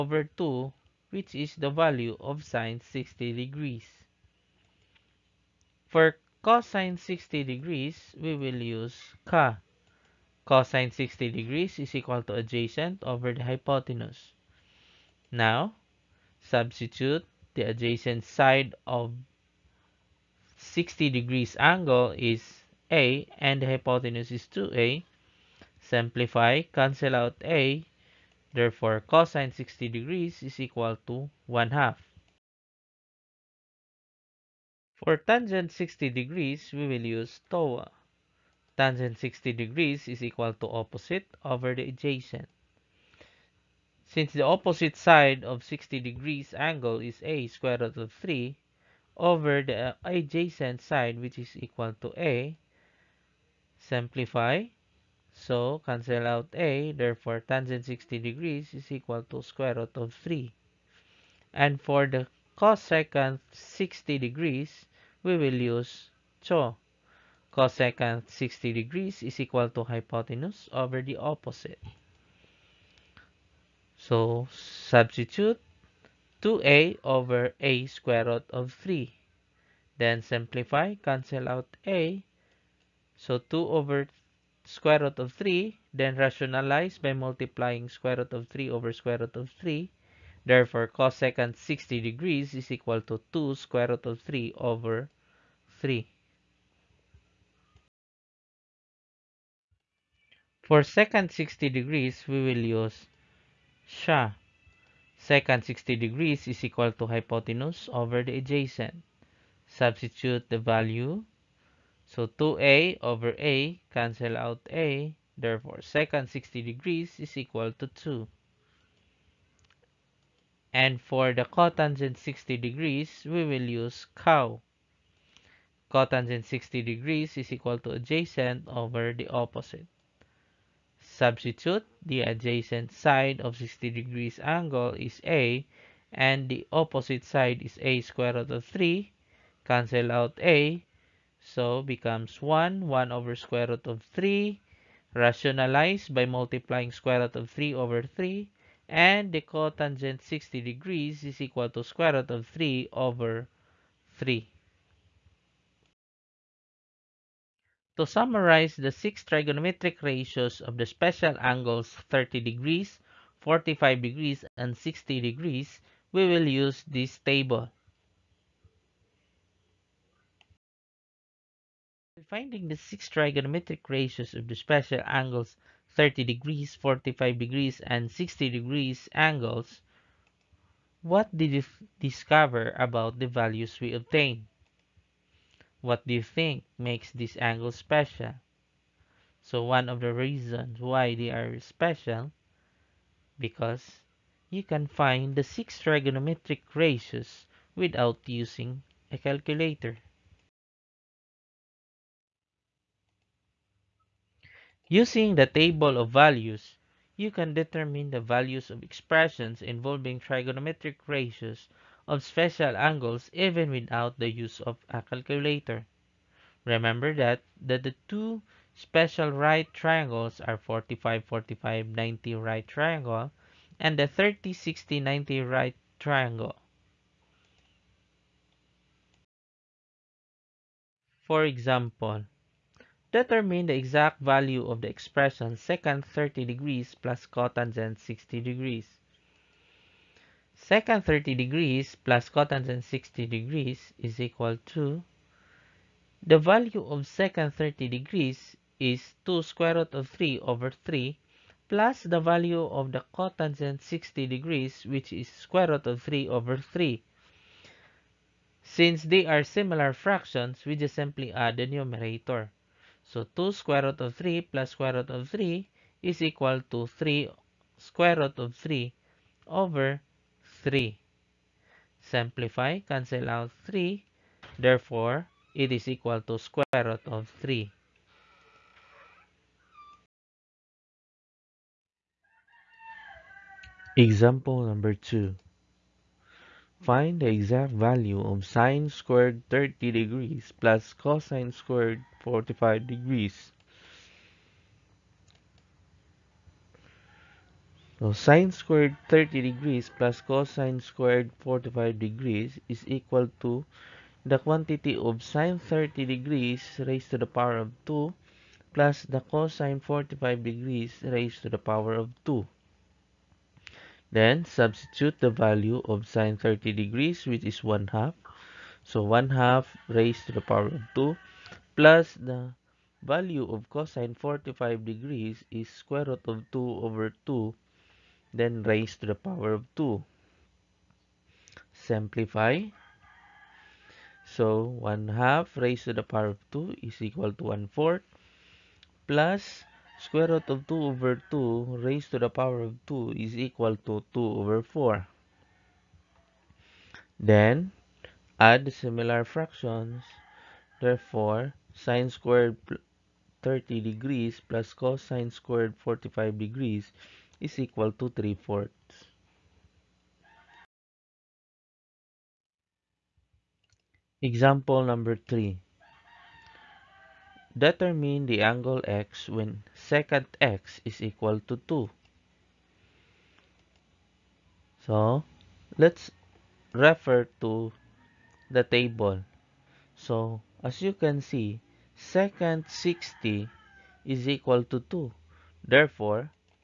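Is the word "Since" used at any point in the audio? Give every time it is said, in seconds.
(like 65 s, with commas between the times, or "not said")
44 s, 258 s.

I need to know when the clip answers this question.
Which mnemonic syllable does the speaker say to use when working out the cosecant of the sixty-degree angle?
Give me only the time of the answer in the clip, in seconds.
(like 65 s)
66 s.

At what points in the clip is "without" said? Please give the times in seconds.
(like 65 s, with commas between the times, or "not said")
197 s, 213 s.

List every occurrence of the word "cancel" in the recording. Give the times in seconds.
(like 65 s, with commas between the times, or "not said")
26 s, 55 s, 80 s, 113 s, 139 s, 272 s.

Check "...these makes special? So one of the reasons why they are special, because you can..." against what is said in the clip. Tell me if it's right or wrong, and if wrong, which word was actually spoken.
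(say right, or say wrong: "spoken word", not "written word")
wrong: "angles", not "makes".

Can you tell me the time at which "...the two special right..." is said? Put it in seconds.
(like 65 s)
217 s.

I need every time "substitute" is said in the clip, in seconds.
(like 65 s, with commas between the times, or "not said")
16 s, 74 s, 109 s, 131 s, 314 s.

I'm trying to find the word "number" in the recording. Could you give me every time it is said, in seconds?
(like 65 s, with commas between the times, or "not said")
284 s, 364 s.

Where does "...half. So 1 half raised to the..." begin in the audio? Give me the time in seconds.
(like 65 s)
317 s.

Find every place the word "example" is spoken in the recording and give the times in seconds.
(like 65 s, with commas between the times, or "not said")
231 s, 283 s, 364 s.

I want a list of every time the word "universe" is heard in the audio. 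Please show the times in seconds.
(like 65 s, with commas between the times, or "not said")
not said.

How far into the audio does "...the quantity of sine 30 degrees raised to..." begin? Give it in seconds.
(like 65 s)
304 s.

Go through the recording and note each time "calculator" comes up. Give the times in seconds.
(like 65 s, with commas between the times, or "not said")
199 s, 215 s.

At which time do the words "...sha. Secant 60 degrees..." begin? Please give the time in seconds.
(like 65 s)
103 s.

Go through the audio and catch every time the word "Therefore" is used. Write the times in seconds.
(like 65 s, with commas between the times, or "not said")
28 s, 56 s, 90 s, 115 s, 274 s, 350 s, 385 s.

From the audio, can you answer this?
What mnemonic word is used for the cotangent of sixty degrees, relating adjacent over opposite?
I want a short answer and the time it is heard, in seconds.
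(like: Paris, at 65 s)
cow, at 124 s.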